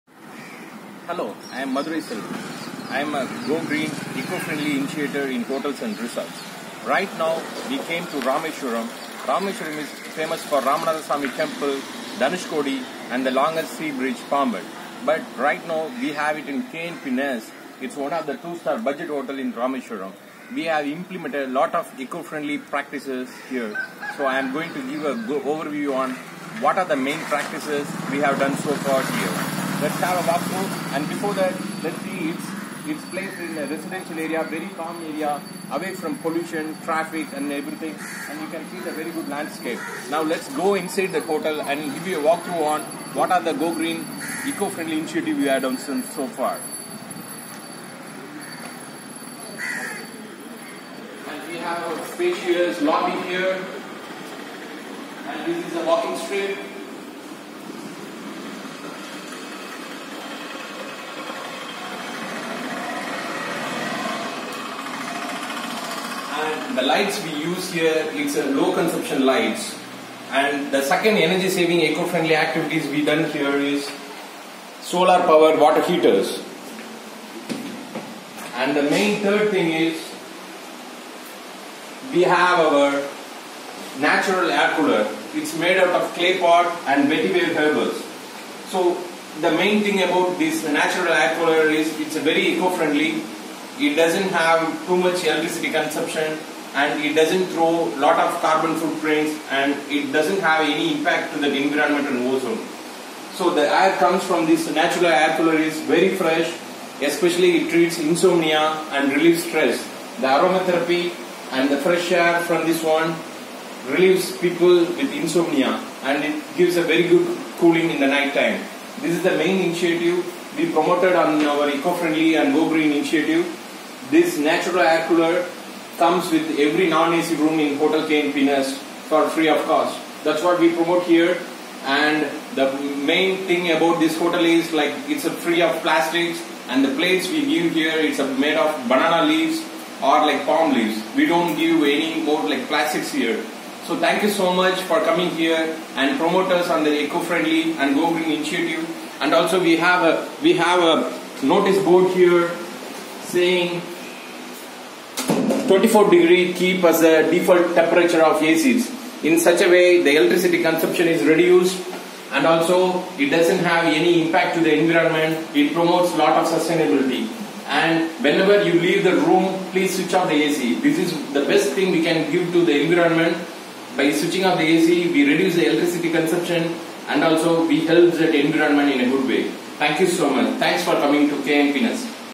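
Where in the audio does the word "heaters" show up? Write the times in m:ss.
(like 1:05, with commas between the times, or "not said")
1:15.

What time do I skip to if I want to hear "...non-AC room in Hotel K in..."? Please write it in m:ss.
2:06.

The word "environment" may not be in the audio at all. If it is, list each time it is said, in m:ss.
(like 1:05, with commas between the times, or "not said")
1:41, 2:44, 2:52, 2:58.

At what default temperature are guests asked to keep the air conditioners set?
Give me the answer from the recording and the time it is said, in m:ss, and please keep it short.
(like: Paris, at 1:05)
24 degrees, at 2:35.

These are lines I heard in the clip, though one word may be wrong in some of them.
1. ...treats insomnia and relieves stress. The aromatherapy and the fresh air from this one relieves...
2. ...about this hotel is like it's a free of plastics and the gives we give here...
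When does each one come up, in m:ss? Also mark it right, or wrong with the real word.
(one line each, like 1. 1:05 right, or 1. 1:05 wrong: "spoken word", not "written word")
1. 1:47 right
2. 2:13 wrong: "plates", not "gives".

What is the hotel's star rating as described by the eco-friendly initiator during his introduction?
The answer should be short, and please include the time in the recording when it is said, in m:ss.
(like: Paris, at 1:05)
Two-star, at 0:18.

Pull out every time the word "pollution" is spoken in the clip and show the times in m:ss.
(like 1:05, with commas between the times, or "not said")
0:36.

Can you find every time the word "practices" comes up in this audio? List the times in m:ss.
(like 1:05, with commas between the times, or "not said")
0:22, 0:27.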